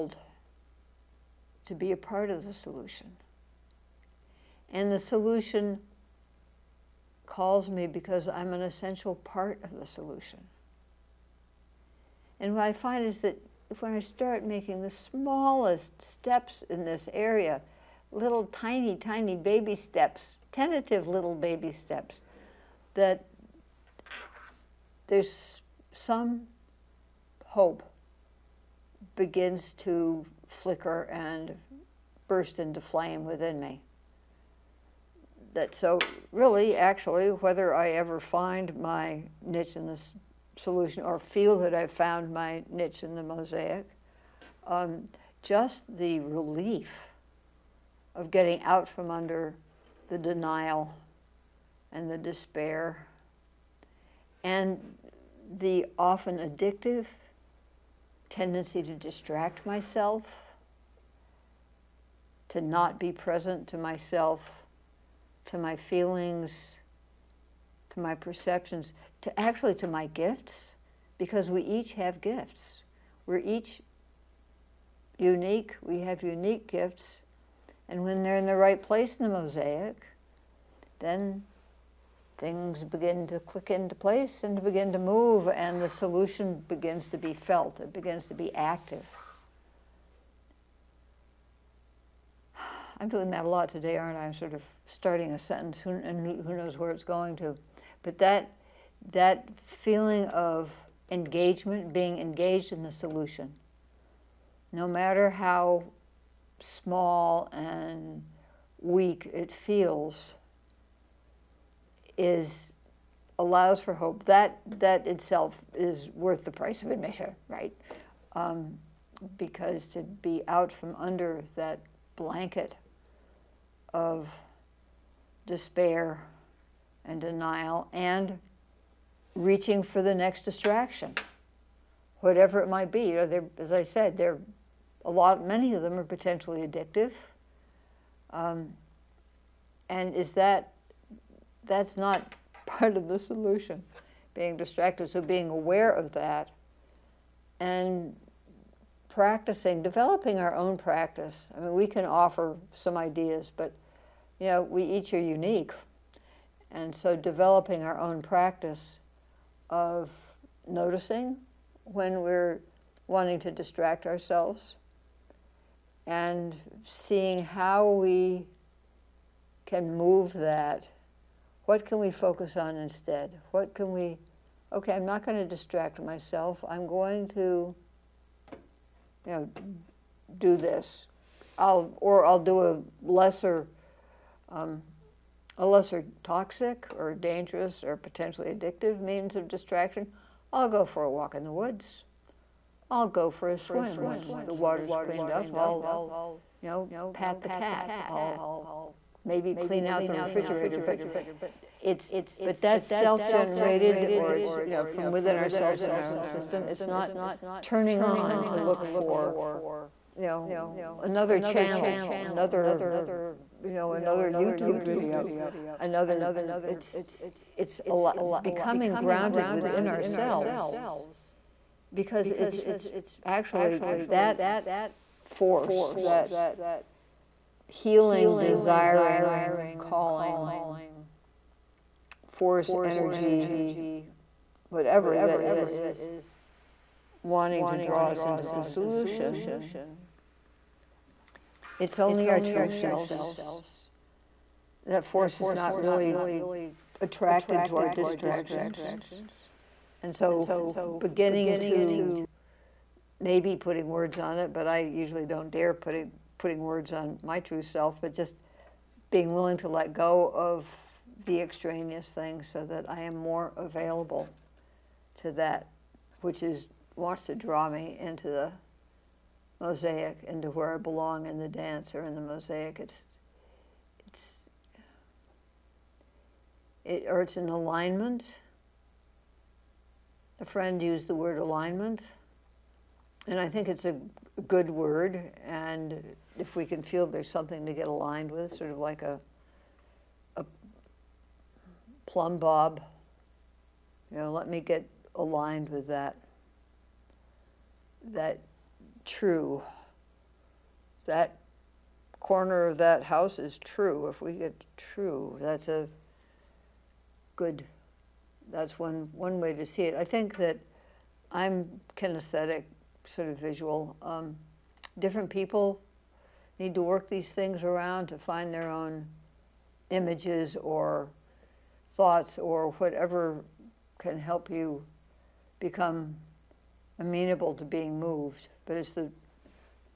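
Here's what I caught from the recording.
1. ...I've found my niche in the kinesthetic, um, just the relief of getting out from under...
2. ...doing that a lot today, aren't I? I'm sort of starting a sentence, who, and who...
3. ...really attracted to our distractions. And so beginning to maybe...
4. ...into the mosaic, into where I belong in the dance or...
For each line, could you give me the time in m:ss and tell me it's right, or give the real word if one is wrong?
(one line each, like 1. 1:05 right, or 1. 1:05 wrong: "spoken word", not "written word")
1. 0:41 wrong: "mosaic", not "kinesthetic"
2. 1:33 right
3. 4:05 right
4. 4:28 right.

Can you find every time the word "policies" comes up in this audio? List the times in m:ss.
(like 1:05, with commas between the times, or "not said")
not said.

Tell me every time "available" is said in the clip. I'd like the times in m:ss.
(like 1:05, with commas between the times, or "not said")
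4:23.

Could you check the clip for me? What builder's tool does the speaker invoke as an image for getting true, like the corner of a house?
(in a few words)
plumb bob.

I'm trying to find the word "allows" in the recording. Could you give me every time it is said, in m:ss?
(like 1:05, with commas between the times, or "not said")
1:53.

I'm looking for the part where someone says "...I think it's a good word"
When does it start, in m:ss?
4:43.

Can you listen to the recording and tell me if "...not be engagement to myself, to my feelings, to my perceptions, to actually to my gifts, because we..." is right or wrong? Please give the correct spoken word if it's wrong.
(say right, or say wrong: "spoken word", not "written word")
wrong: "present", not "engagement".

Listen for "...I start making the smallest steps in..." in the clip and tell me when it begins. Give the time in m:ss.
0:13.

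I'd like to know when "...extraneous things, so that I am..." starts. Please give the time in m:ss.
4:21.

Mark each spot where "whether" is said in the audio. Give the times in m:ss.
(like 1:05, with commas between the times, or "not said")
0:37.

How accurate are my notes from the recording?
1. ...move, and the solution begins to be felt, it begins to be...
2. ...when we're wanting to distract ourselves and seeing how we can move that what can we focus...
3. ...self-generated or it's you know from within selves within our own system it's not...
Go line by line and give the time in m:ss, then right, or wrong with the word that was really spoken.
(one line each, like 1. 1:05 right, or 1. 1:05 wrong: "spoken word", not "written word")
1. 1:24 right
2. 2:41 right
3. 3:22 wrong: "ourselves", not "selves".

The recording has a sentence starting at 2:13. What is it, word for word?
You know, as I said, there a lot, many of them are potentially addictive.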